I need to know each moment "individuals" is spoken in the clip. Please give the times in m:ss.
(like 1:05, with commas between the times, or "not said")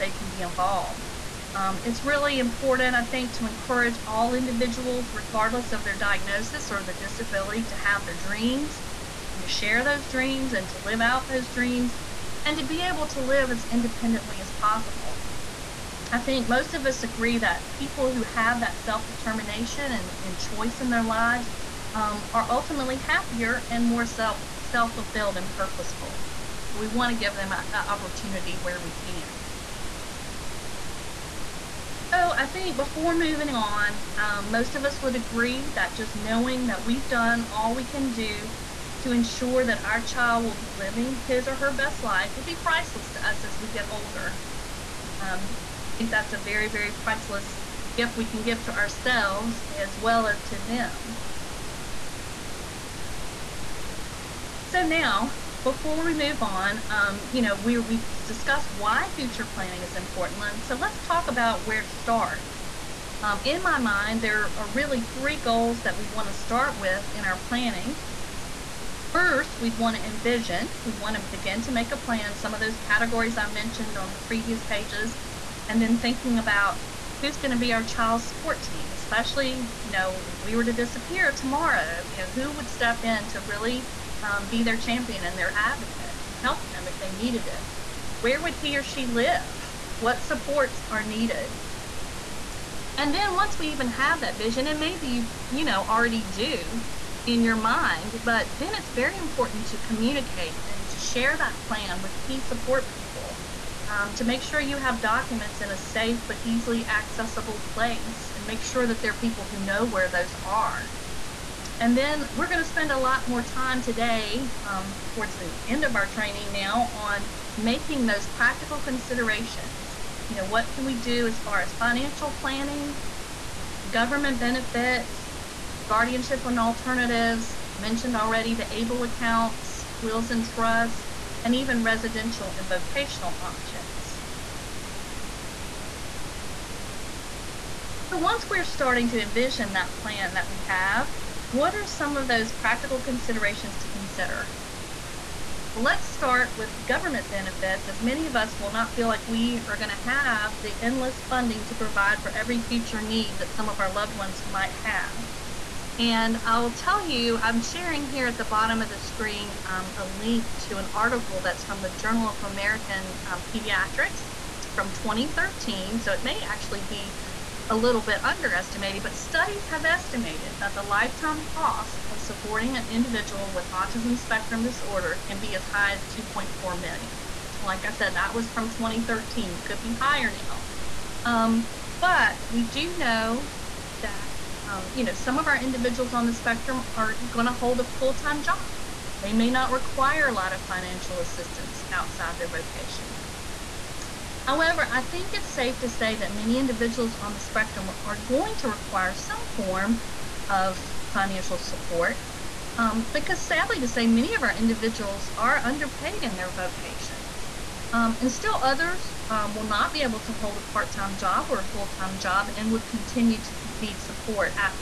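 0:04, 2:52, 3:05, 3:16, 3:24.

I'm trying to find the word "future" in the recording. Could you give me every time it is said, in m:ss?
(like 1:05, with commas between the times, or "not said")
0:59, 2:32.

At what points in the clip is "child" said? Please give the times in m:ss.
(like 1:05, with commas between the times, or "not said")
0:40, 1:17.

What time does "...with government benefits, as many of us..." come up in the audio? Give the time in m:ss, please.
2:26.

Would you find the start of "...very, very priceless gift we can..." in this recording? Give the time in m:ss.
0:46.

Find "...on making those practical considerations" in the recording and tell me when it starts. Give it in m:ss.
1:56.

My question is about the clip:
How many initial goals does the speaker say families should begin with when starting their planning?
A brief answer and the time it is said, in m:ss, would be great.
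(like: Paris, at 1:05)
3, at 1:05.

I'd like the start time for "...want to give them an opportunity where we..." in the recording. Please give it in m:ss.
0:26.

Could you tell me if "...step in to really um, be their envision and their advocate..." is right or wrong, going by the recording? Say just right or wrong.
wrong.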